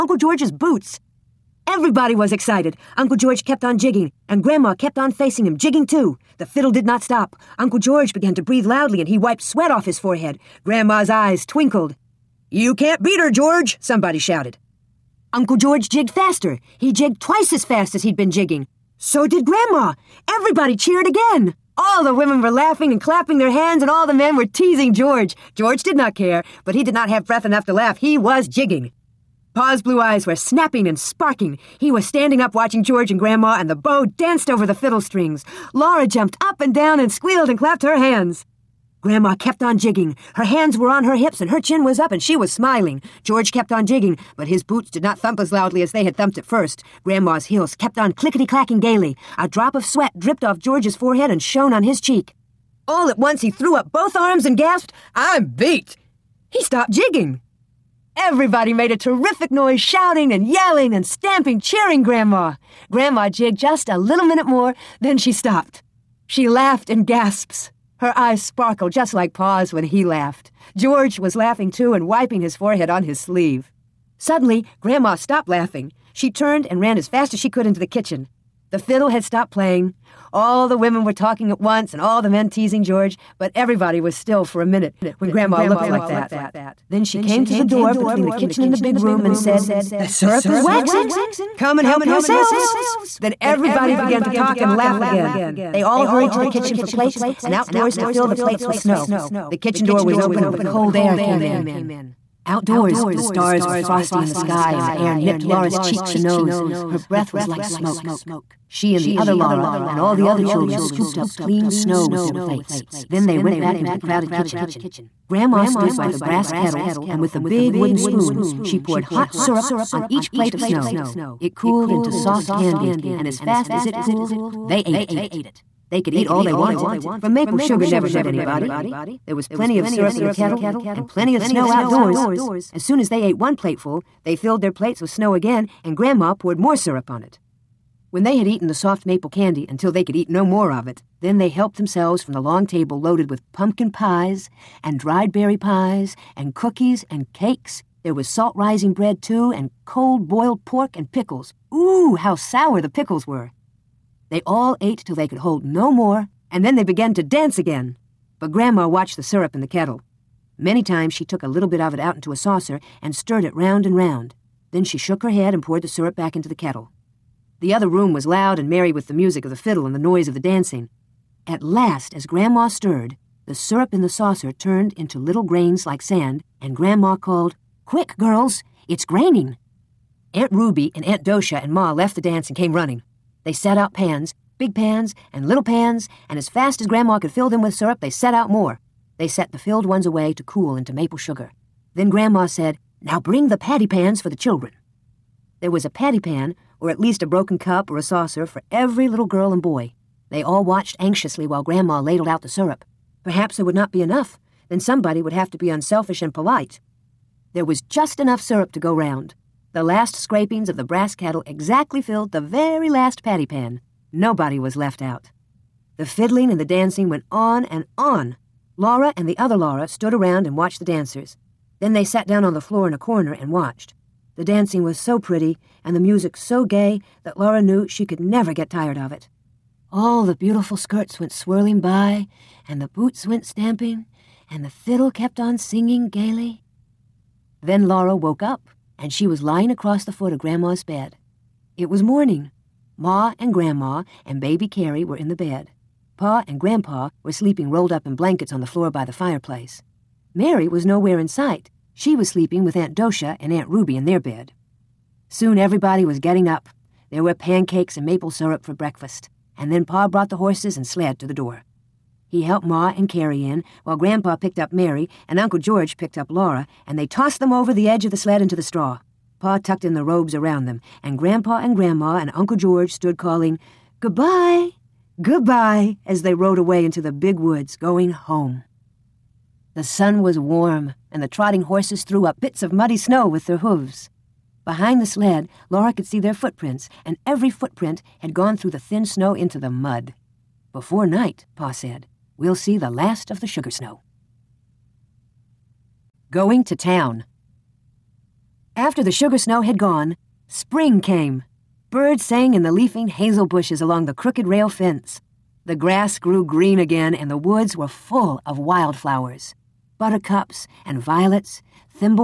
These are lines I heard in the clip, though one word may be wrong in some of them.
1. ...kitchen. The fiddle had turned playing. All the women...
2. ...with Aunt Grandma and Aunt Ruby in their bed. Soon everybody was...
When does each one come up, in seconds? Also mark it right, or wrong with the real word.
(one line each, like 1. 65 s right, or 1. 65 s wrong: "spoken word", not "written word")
1. 77 s wrong: "stopped", not "turned"
2. 252 s wrong: "Docia", not "Grandma".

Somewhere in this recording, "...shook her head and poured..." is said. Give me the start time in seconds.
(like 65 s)
164 s.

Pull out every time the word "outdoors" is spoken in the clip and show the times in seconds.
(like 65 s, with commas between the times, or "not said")
97 s, 102 s, 131 s.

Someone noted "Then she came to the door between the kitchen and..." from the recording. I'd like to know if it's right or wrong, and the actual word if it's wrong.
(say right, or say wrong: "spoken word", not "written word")
right.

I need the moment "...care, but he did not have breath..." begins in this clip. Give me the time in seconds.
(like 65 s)
26 s.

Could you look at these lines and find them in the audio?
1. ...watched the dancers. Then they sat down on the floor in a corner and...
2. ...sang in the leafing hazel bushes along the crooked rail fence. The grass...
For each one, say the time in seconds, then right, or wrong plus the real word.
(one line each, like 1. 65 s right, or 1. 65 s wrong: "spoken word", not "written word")
1. 220 s right
2. 302 s right.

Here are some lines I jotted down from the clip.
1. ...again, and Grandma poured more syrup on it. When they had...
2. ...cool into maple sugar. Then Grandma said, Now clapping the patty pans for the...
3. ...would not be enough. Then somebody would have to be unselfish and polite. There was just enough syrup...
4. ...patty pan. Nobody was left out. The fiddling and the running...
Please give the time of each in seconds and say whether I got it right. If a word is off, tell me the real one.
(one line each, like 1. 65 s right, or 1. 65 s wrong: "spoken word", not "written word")
1. 135 s right
2. 190 s wrong: "bring", not "clapping"
3. 203 s right
4. 213 s wrong: "dancing", not "running".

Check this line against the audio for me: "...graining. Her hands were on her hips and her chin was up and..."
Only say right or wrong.
wrong.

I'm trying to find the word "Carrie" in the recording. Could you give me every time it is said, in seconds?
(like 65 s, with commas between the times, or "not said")
244 s, 263 s.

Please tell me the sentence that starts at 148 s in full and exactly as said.
There was salt rising bread, too, and cold boiled pork and pickles.